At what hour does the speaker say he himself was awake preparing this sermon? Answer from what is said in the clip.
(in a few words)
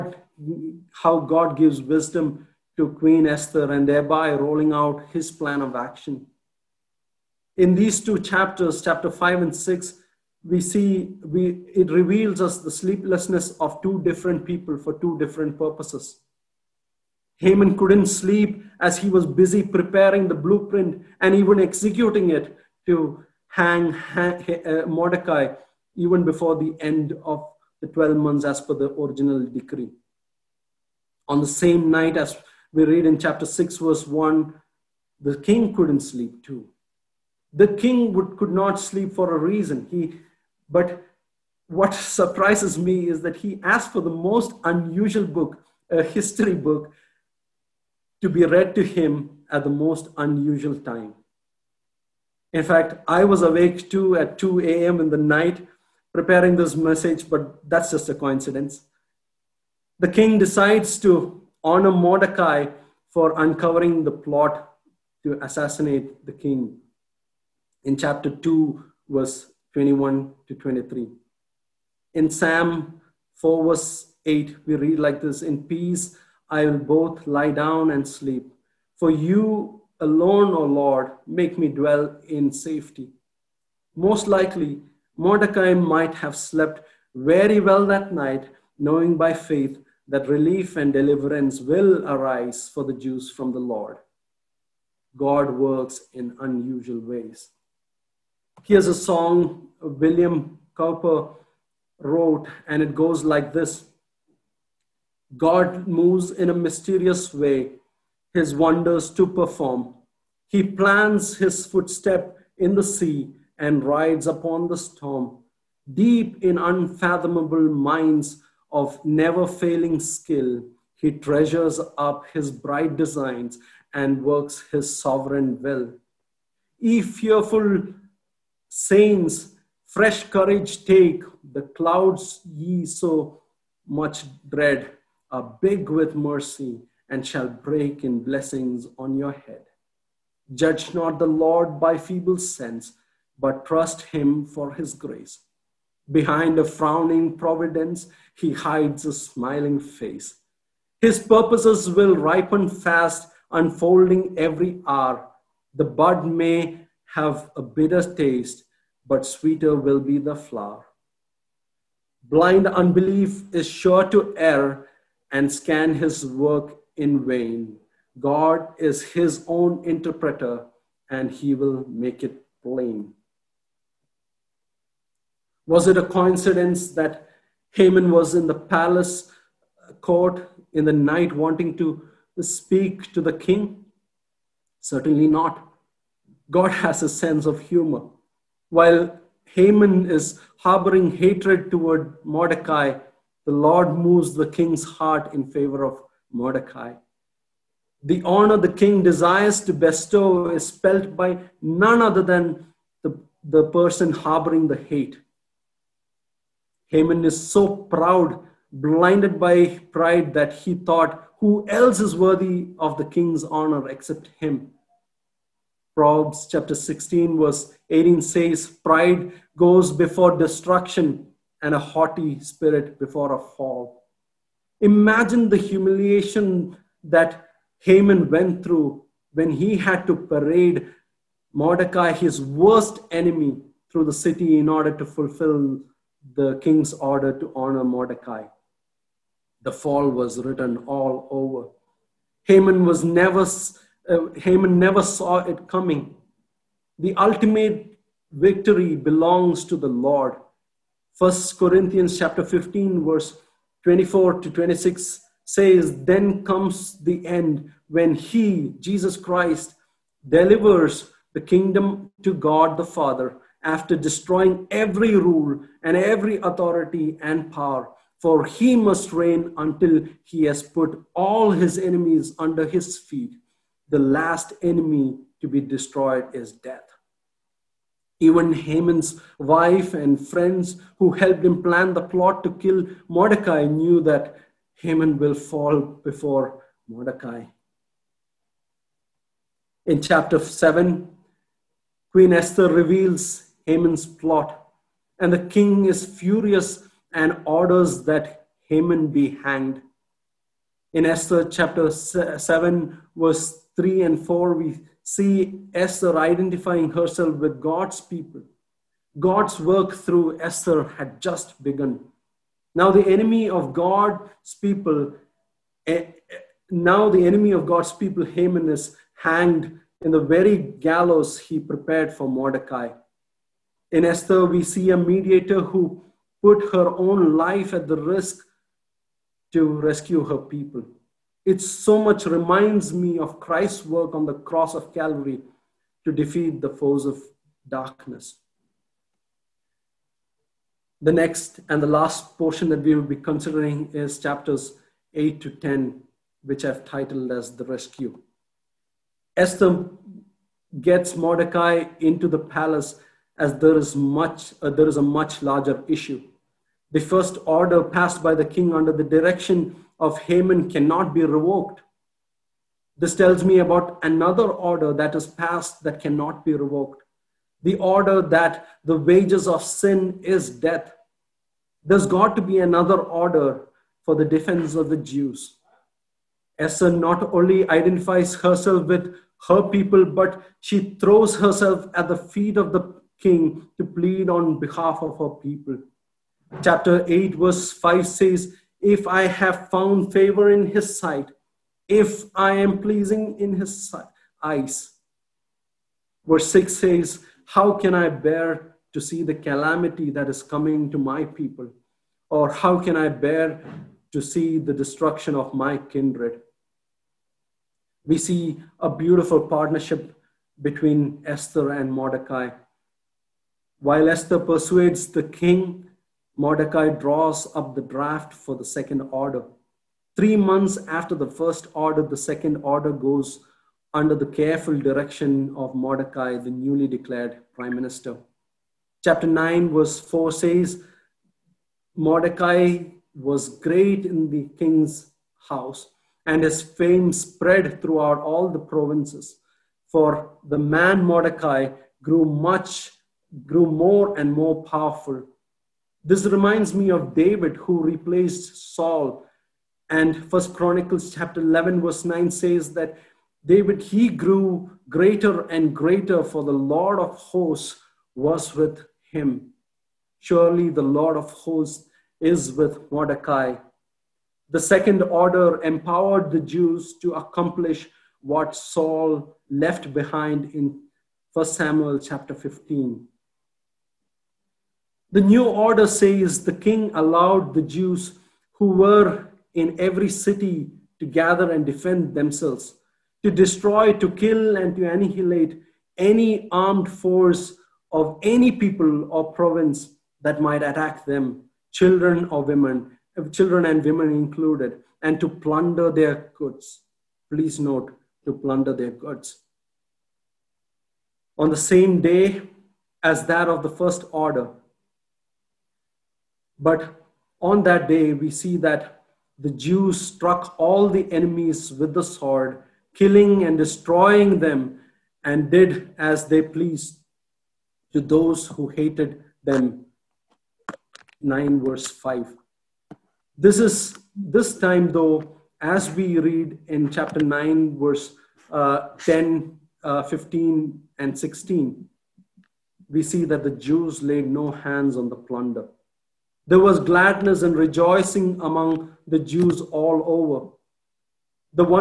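2 a.m.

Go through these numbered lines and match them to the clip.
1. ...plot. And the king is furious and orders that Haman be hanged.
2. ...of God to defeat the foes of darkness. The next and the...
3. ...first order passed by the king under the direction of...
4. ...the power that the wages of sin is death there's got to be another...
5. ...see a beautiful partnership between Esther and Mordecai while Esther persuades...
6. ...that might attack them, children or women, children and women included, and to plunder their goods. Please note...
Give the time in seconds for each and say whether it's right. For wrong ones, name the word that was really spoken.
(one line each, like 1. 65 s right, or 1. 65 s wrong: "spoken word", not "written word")
1. 294 s right
2. 334 s wrong: "Calvary", not "God"
3. 357 s right
4. 367 s wrong: "order", not "power"
5. 408 s right
6. 490 s right.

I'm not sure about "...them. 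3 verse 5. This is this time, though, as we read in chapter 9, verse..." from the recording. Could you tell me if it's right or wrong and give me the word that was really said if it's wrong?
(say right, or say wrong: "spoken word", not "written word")
wrong: "9", not "3".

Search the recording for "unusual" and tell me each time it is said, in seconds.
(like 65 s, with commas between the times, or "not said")
44 s, 50 s, 96 s.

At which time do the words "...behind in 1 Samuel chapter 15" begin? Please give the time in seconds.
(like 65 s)
469 s.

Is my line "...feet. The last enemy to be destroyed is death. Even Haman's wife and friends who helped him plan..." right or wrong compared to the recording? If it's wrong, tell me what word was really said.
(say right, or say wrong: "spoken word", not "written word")
right.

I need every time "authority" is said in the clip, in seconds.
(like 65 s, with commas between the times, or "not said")
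266 s.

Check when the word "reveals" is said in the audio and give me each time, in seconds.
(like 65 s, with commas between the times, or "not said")
11 s, 292 s.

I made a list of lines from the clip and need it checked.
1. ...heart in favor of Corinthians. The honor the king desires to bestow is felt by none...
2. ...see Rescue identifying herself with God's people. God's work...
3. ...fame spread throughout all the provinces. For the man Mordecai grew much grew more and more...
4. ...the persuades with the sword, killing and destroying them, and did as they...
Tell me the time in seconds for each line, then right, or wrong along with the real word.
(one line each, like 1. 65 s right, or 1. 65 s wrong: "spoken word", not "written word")
1. 194 s wrong: "Mordecai", not "Corinthians"
2. 305 s wrong: "Esther", not "Rescue"
3. 436 s right
4. 510 s wrong: "enemies", not "persuades".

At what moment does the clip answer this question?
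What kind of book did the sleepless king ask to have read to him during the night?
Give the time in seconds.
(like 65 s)
45 s.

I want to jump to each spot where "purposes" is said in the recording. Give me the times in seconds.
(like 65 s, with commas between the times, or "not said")
15 s, 151 s.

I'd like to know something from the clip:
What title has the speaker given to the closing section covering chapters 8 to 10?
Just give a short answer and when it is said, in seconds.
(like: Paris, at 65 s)
The Rescue, at 347 s.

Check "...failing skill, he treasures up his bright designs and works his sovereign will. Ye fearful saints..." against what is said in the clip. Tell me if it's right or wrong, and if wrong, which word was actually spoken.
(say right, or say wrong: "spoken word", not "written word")
right.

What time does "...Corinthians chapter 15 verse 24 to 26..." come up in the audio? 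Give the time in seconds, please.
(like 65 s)
251 s.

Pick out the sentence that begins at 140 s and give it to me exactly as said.
Judge not the Lord by feeble sense, but trust him for his grace.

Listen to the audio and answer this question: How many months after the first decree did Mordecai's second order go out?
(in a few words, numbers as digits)
3.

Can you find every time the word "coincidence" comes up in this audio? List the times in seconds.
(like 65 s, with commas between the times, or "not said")
58 s, 176 s.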